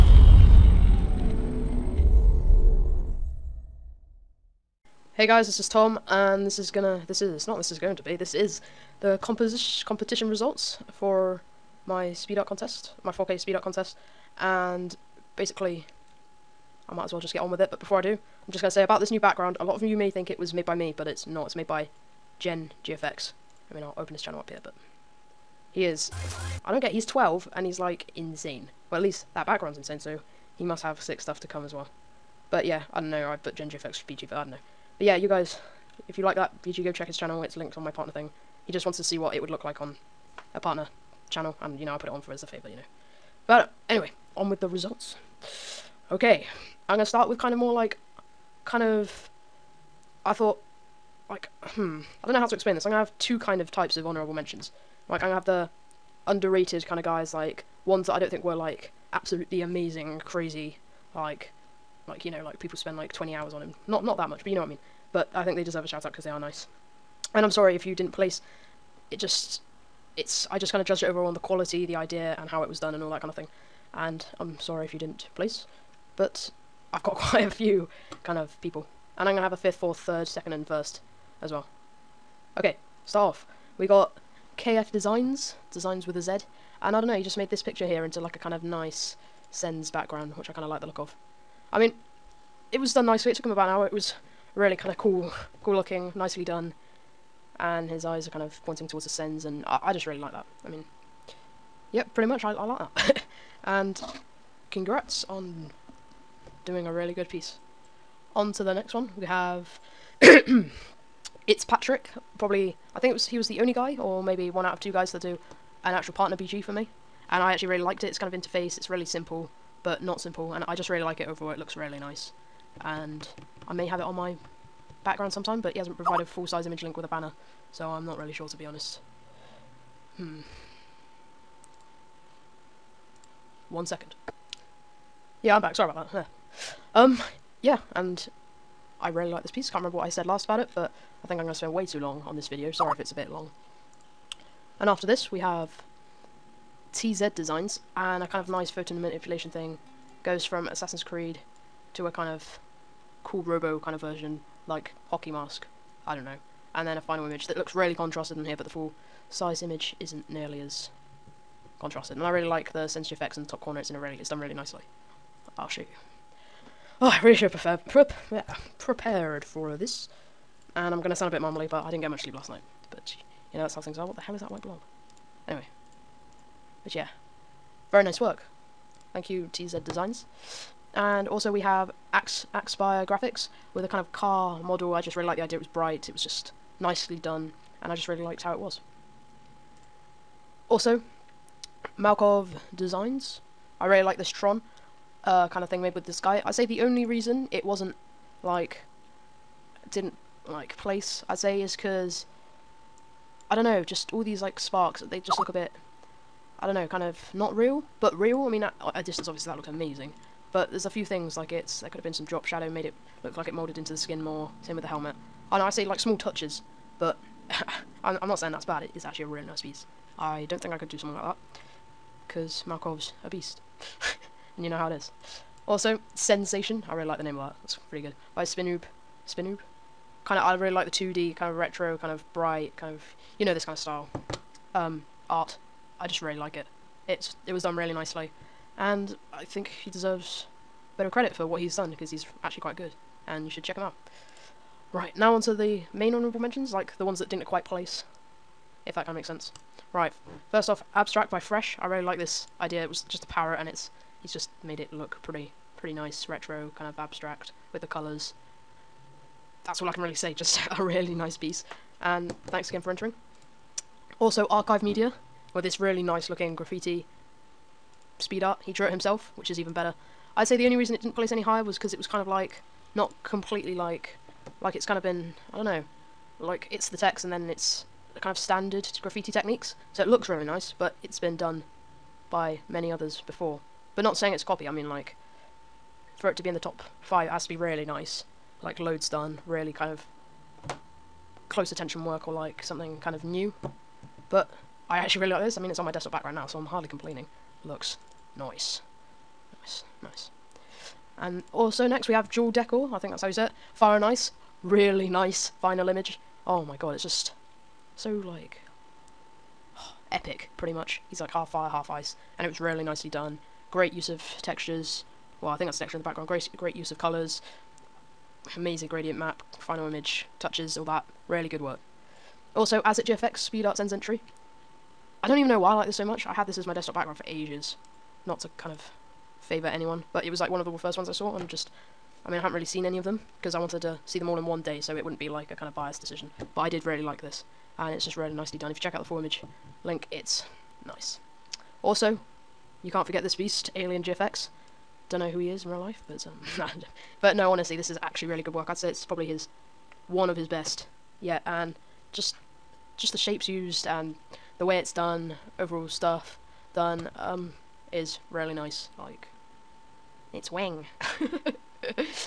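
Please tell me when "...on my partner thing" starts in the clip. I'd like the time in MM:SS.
00:37.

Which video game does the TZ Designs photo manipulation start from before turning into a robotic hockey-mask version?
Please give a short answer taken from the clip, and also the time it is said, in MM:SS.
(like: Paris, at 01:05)
Assassin's Creed, at 02:30.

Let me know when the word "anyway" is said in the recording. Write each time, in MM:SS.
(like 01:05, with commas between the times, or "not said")
00:43, 02:55.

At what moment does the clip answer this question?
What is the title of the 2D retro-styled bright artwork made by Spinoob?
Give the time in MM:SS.
03:46.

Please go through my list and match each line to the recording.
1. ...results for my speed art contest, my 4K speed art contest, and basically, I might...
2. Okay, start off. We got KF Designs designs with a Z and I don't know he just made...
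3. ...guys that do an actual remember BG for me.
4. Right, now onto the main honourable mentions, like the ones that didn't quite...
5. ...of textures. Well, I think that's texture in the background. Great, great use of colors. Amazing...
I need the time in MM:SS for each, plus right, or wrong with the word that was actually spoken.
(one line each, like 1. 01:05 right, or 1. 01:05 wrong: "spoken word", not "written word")
1. 00:10 right
2. 01:22 right
3. 01:54 wrong: "partner", not "remember"
4. 04:04 right
5. 05:14 right.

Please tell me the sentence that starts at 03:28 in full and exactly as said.
I mean, at a distance, obviously, that looks amazing.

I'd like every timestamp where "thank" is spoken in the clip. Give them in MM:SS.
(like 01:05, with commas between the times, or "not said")
02:59, 04:22.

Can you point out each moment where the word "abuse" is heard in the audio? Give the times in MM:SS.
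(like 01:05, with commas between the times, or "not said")
not said.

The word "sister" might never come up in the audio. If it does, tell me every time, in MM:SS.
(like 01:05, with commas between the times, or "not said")
not said.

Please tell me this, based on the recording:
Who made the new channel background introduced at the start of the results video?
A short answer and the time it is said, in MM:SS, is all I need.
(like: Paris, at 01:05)
Gen GFX, at 00:22.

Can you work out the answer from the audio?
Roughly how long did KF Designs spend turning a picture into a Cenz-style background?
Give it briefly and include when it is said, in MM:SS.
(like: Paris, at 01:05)
about an hour, at 01:33.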